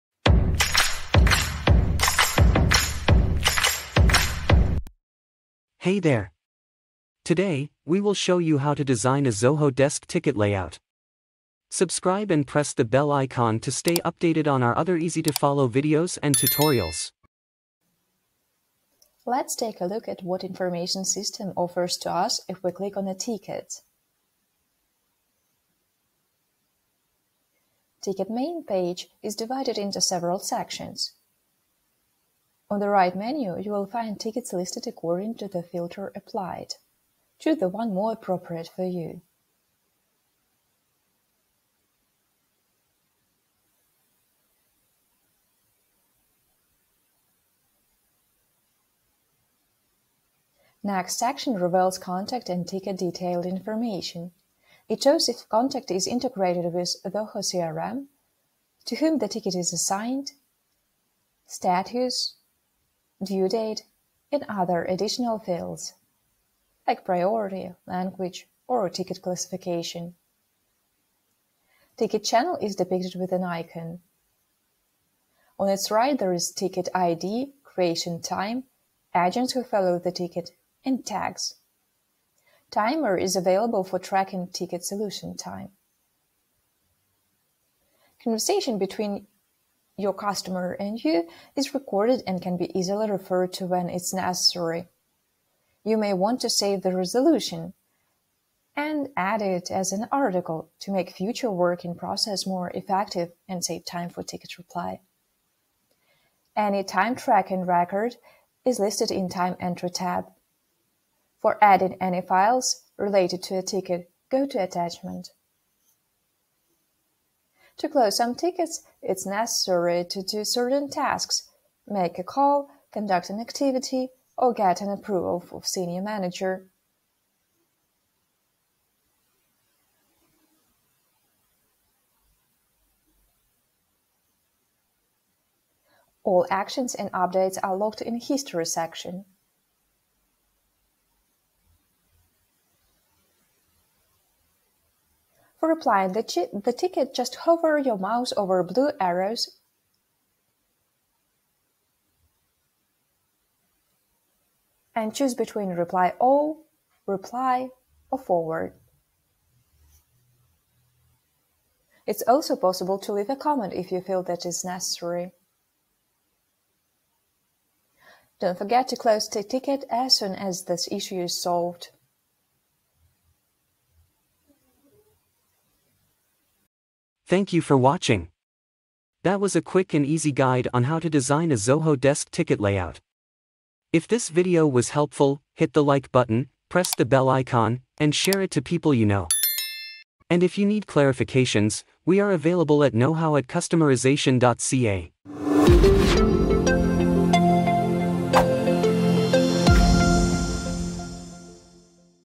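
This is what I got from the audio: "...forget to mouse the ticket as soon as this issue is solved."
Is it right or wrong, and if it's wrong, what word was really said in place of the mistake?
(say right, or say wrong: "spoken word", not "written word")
wrong: "close", not "mouse".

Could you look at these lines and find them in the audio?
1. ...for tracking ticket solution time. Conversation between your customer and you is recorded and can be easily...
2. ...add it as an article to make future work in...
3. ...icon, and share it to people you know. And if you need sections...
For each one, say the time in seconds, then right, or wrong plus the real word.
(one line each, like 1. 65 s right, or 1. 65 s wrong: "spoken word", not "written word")
1. 83 s right
2. 99 s right
3. 187 s wrong: "clarifications", not "sections".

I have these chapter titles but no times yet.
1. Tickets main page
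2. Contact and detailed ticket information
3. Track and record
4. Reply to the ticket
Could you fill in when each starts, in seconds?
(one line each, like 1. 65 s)
1. 29 s
2. 53 s
3. 82 s
4. 145 s.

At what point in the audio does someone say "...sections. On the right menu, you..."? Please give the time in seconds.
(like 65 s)
30 s.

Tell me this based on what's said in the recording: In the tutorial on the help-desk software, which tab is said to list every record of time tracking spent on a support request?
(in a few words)
Time Entry.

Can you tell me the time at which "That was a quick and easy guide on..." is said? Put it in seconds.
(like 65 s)
179 s.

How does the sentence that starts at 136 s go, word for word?
All actions and updates are logged in History section.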